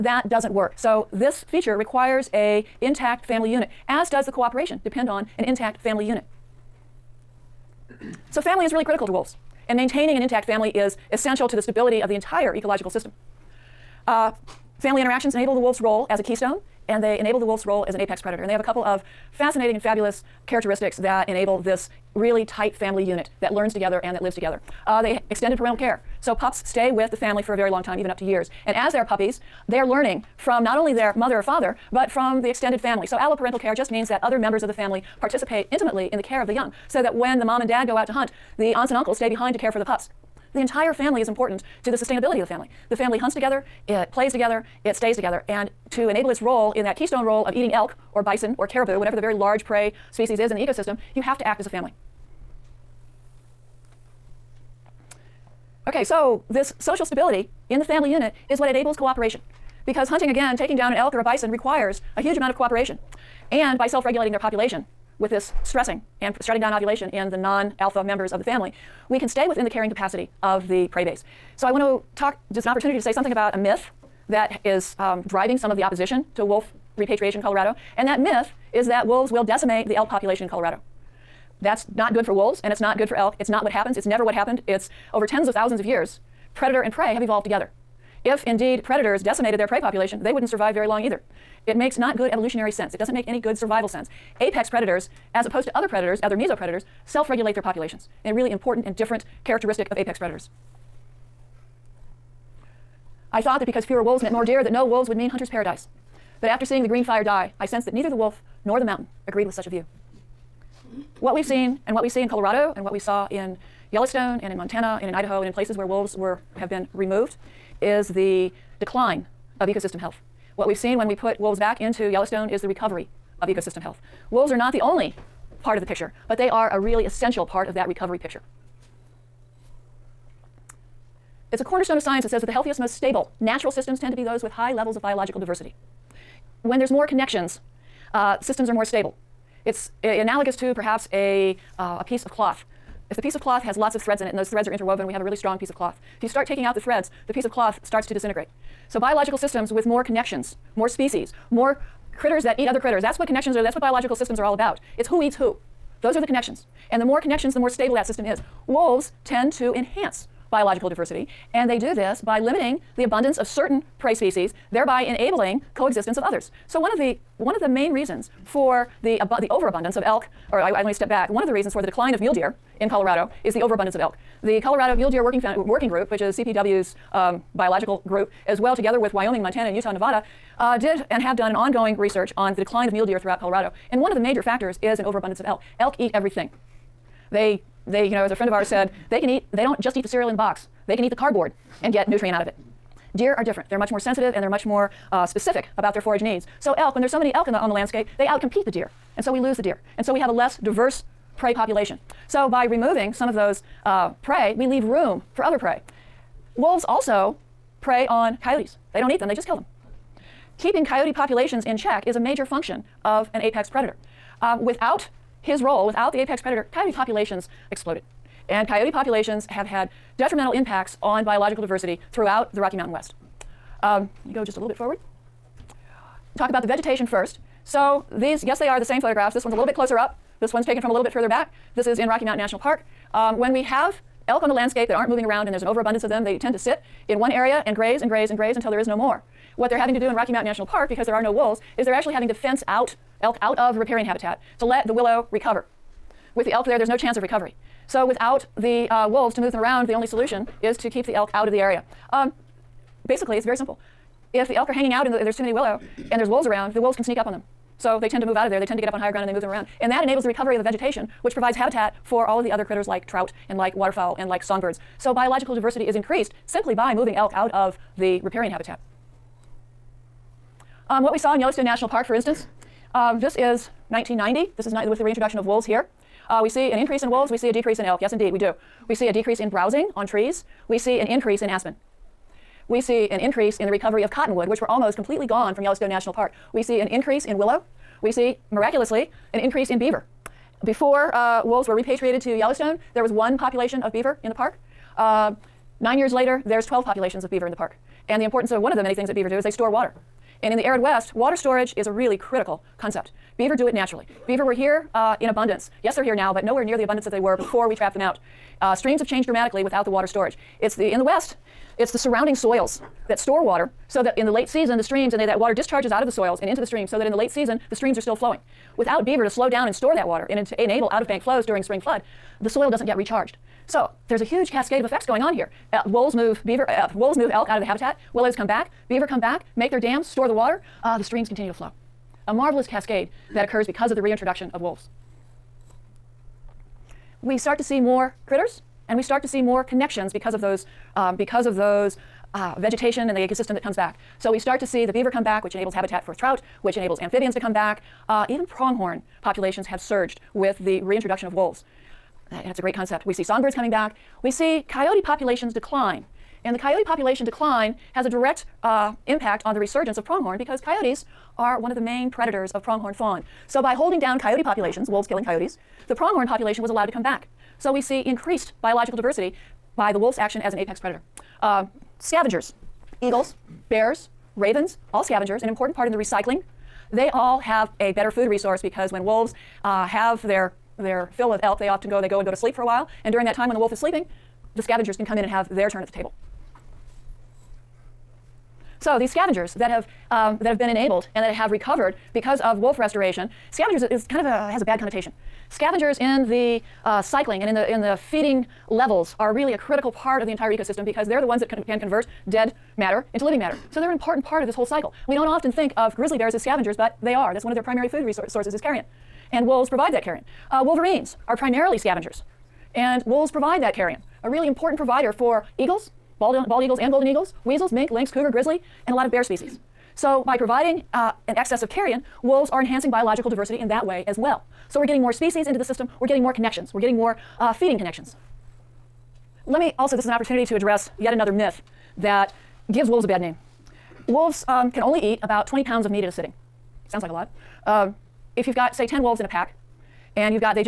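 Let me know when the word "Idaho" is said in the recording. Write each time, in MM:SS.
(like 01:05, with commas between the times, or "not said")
01:55.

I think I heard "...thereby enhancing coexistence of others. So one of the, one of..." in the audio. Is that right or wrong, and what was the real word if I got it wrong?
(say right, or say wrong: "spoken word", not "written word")
wrong: "enabling", not "enhancing".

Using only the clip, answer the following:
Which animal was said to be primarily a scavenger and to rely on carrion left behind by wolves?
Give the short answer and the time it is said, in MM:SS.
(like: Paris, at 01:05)
Wolverines, at 06:50.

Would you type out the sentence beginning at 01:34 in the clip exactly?
Apex predators, as opposed to other predators, other mesopredators, self regulate their populations.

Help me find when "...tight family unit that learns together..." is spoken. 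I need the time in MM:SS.
00:22.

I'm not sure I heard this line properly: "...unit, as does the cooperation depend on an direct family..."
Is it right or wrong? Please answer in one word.
wrong.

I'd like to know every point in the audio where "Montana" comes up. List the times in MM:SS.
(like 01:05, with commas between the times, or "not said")
01:54, 02:59.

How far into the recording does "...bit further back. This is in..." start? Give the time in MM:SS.
03:51.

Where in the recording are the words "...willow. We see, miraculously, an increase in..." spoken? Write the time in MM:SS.
04:47.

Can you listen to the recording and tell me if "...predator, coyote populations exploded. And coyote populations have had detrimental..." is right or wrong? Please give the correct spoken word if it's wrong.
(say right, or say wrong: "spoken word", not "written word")
right.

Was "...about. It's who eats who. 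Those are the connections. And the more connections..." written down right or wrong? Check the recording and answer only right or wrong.
right.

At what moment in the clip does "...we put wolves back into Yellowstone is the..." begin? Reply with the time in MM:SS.
02:01.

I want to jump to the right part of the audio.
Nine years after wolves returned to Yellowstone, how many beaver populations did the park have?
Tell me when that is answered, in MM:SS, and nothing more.
04:56.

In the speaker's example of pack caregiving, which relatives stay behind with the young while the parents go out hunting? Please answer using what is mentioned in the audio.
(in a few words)
Aunts and uncles.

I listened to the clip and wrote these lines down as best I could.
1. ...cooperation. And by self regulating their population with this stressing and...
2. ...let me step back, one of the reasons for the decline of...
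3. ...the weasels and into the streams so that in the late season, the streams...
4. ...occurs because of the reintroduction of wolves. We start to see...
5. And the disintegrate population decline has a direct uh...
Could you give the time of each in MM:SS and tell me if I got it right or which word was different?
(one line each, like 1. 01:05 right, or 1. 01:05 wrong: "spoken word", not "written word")
1. 01:02 right
2. 02:50 right
3. 05:16 wrong: "soils", not "weasels"
4. 05:33 right
5. 05:56 wrong: "coyote", not "disintegrate".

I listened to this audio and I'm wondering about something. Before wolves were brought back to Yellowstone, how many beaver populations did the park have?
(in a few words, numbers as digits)
1.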